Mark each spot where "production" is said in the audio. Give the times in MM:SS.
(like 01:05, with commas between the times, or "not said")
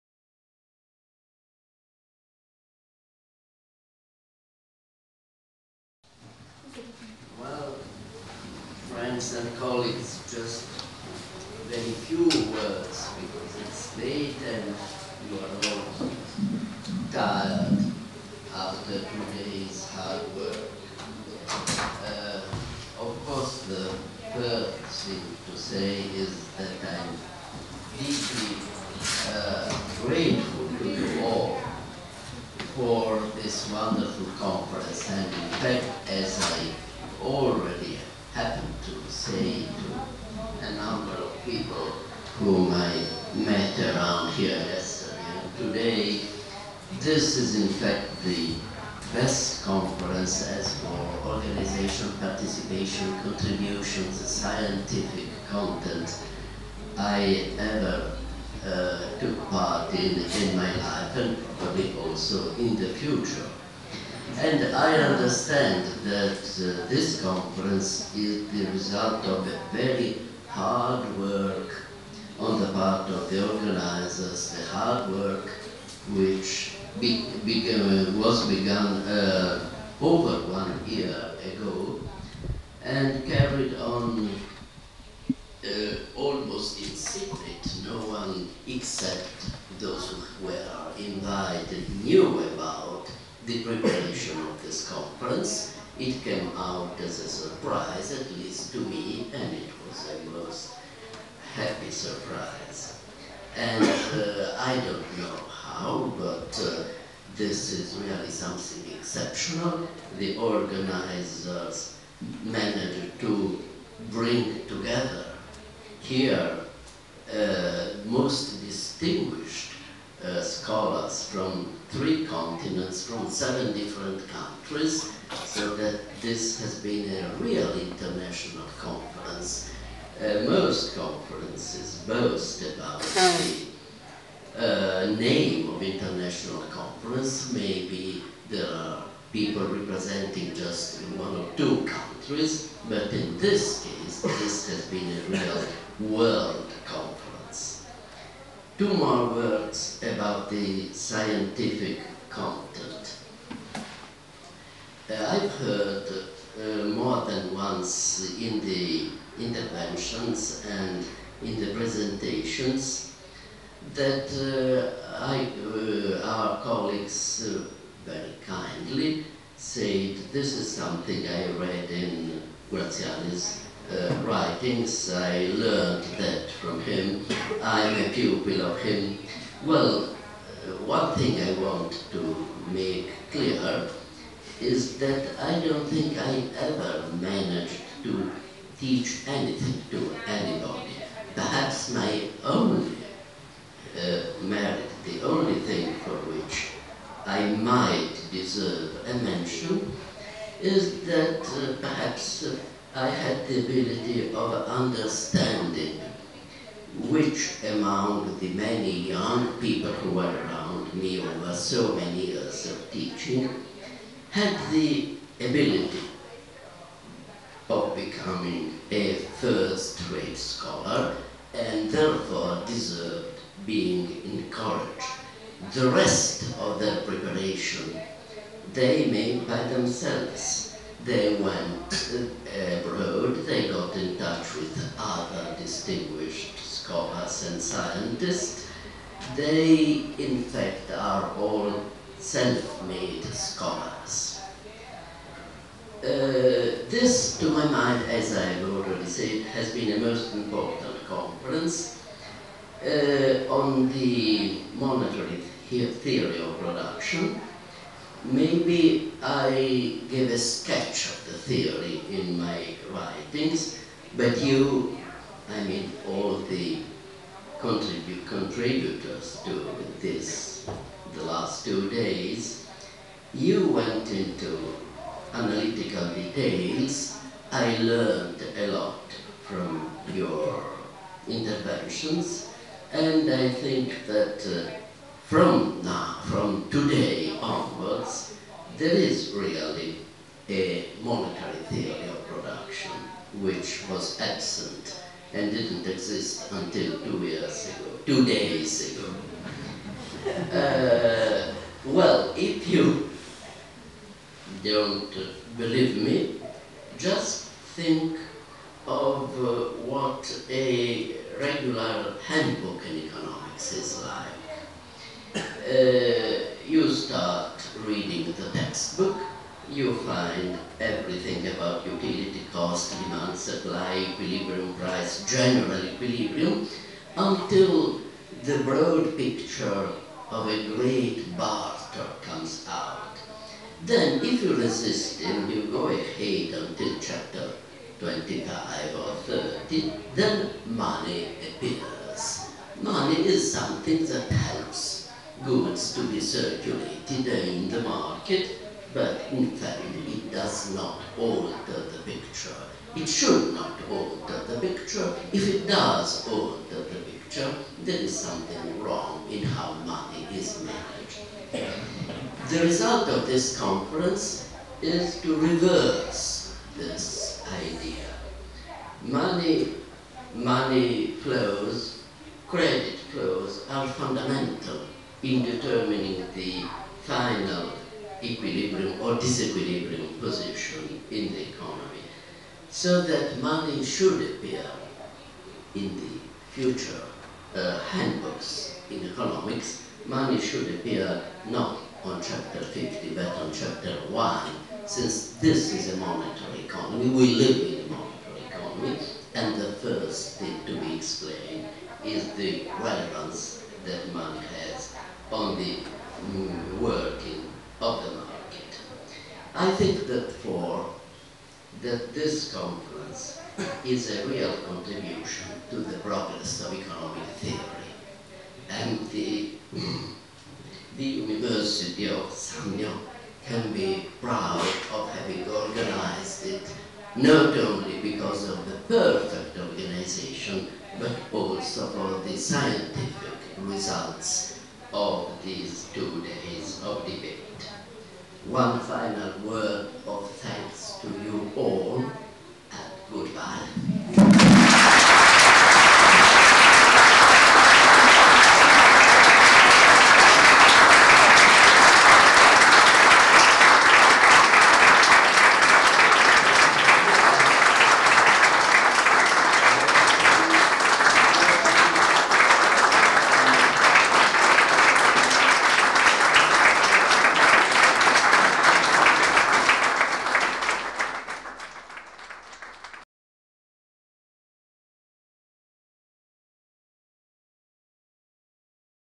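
04:16, 04:52.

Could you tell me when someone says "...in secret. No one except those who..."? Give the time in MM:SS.
01:26.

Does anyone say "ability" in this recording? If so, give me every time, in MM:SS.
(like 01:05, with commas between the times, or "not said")
03:23, 03:35.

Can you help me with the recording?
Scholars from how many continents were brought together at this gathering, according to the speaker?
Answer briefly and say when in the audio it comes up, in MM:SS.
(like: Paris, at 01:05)
3, at 02:01.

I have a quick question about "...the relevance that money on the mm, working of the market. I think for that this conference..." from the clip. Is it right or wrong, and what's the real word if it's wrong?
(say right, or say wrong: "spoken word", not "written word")
right.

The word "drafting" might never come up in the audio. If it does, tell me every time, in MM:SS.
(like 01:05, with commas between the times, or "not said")
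not said.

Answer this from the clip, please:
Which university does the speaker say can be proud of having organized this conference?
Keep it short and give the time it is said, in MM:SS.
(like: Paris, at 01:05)
University of Sannio, at 07:01.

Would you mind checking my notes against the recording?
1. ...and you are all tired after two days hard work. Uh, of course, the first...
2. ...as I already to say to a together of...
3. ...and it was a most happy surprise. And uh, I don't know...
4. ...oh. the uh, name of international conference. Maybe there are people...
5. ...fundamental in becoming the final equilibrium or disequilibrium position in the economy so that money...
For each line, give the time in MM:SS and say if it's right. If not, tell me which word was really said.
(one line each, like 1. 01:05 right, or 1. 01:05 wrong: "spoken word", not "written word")
1. 00:14 right
2. 00:36 wrong: "number", not "together"
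3. 01:39 right
4. 02:13 right
5. 06:13 wrong: "determining", not "becoming".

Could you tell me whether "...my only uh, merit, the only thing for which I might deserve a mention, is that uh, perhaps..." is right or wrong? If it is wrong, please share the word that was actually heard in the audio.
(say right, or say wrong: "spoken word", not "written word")
right.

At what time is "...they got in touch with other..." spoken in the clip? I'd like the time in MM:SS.
03:53.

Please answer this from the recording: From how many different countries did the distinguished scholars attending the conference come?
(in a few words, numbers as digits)
7.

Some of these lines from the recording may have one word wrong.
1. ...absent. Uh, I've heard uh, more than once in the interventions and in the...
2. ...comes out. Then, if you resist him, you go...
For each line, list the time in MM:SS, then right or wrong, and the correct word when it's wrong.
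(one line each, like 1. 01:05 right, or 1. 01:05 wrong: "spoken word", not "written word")
1. 02:32 wrong: "content", not "absent"
2. 05:32 right.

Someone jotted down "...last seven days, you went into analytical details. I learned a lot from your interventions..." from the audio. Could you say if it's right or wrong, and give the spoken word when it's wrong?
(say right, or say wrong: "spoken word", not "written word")
wrong: "two", not "seven".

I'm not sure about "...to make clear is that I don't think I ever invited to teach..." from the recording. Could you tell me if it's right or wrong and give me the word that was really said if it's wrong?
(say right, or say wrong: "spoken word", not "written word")
wrong: "managed", not "invited".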